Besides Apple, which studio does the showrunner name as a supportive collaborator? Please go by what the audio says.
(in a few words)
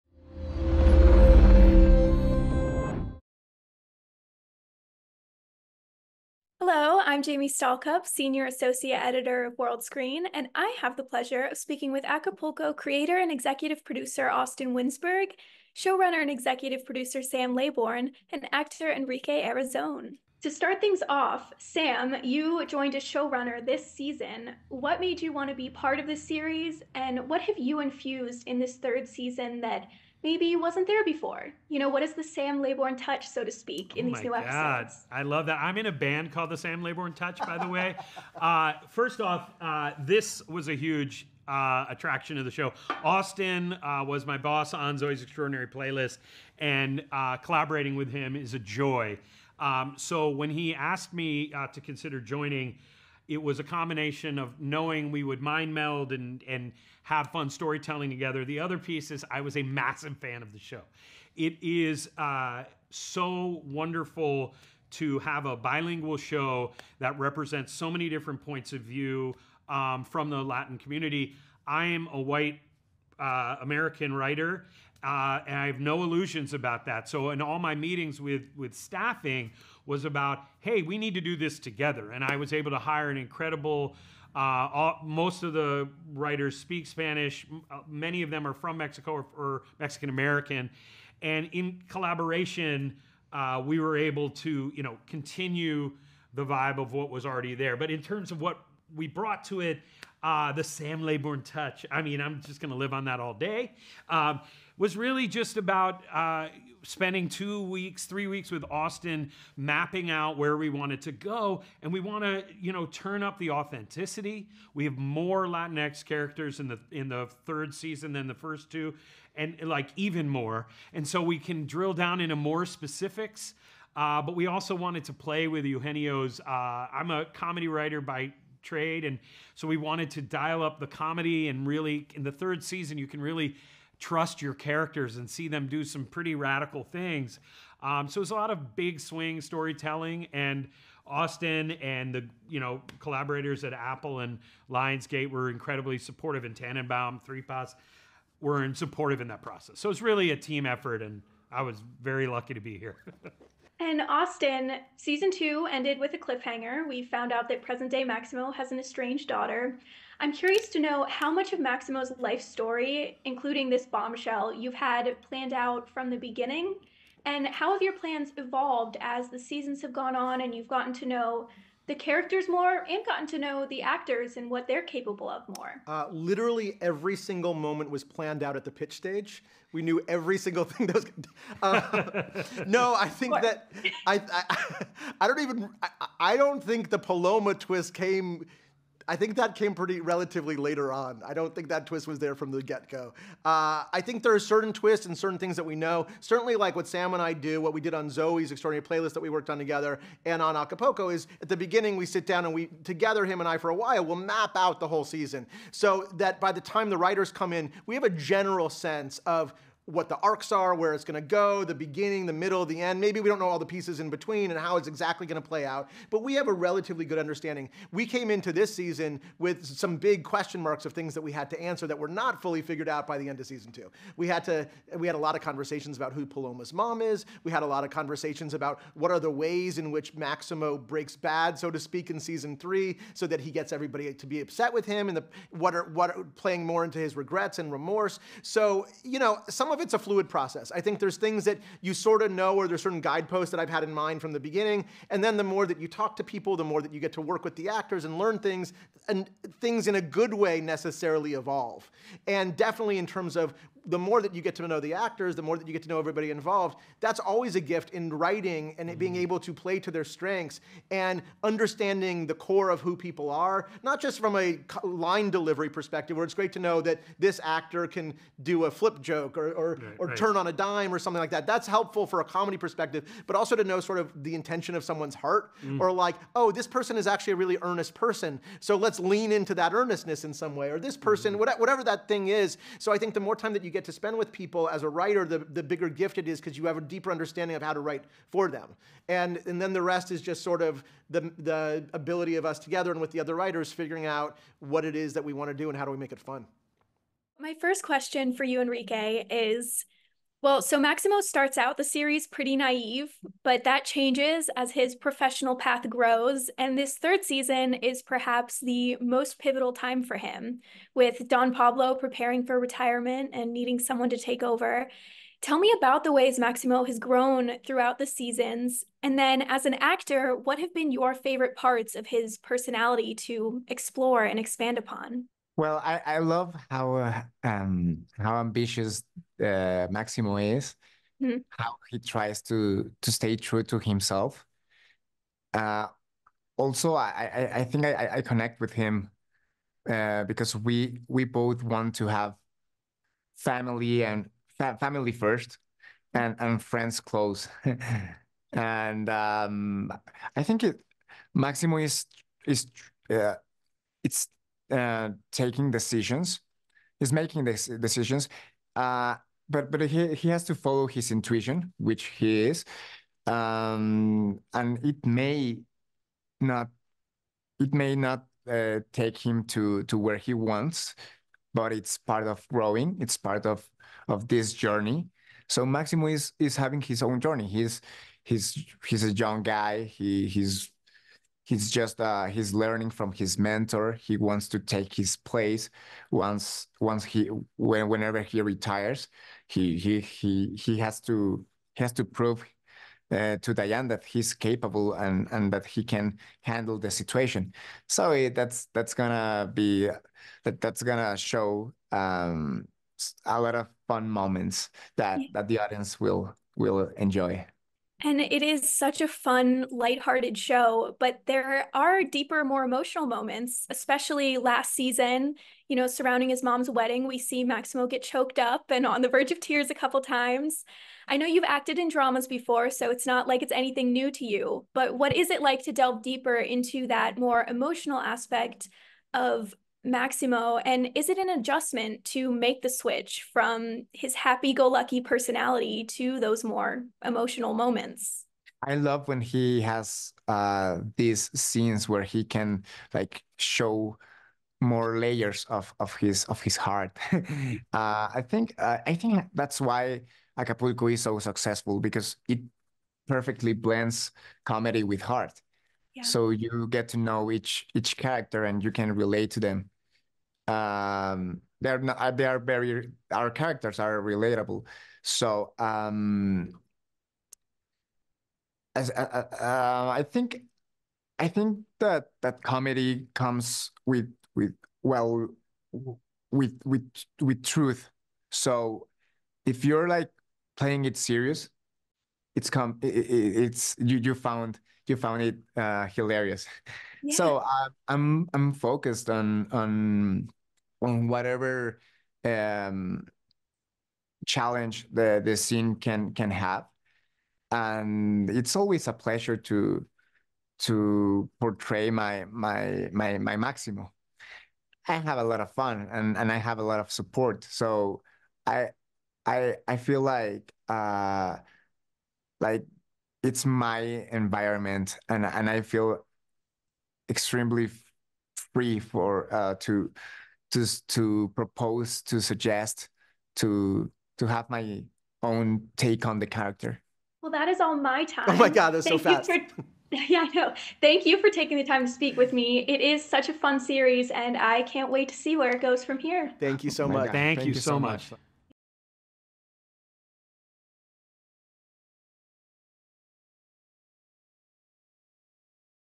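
Lionsgate.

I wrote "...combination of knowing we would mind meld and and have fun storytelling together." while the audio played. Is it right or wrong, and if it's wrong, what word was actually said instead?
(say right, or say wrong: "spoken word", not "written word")
right.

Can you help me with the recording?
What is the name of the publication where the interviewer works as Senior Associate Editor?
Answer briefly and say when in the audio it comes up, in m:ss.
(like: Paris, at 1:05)
World Screen, at 0:09.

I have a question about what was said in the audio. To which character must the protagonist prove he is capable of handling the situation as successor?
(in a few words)
Diane.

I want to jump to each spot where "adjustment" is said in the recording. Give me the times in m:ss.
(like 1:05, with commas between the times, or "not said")
7:11.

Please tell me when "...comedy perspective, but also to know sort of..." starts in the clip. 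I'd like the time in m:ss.
4:32.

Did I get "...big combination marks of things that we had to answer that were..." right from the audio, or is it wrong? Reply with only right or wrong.
wrong.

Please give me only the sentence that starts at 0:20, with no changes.
To start things off, Sam, you joined as showrunner this season.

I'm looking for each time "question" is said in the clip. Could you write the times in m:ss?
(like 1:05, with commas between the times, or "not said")
3:40, 4:57.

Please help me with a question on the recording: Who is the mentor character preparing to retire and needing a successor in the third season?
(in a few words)
Don Pablo.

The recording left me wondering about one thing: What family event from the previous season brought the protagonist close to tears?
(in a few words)
his mom's wedding.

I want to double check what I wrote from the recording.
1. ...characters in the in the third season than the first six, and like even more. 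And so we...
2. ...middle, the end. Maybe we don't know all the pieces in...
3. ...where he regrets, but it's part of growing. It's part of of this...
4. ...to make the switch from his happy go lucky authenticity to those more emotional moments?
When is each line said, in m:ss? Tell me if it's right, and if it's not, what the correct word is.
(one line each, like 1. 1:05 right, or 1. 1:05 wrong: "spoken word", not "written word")
1. 1:56 wrong: "two", not "six"
2. 3:32 right
3. 6:09 wrong: "wants", not "regrets"
4. 7:12 wrong: "personality", not "authenticity".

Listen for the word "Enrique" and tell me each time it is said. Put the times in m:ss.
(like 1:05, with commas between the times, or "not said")
0:18, 4:58.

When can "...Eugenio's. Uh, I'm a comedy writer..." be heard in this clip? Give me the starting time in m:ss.
2:05.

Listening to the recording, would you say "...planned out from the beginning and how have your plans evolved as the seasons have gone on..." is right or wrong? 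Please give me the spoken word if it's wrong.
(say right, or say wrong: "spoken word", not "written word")
right.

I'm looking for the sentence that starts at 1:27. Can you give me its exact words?
Uh, many of them are from Mexico or, or Mexican American.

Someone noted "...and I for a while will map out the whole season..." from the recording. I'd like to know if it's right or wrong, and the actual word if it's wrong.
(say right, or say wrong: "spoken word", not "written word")
right.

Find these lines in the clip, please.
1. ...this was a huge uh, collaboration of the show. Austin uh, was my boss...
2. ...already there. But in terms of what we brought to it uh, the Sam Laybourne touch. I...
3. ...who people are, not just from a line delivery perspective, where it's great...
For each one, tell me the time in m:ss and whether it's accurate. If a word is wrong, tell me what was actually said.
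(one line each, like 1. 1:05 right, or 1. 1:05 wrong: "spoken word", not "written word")
1. 0:39 wrong: "attraction", not "collaboration"
2. 1:37 right
3. 4:22 right.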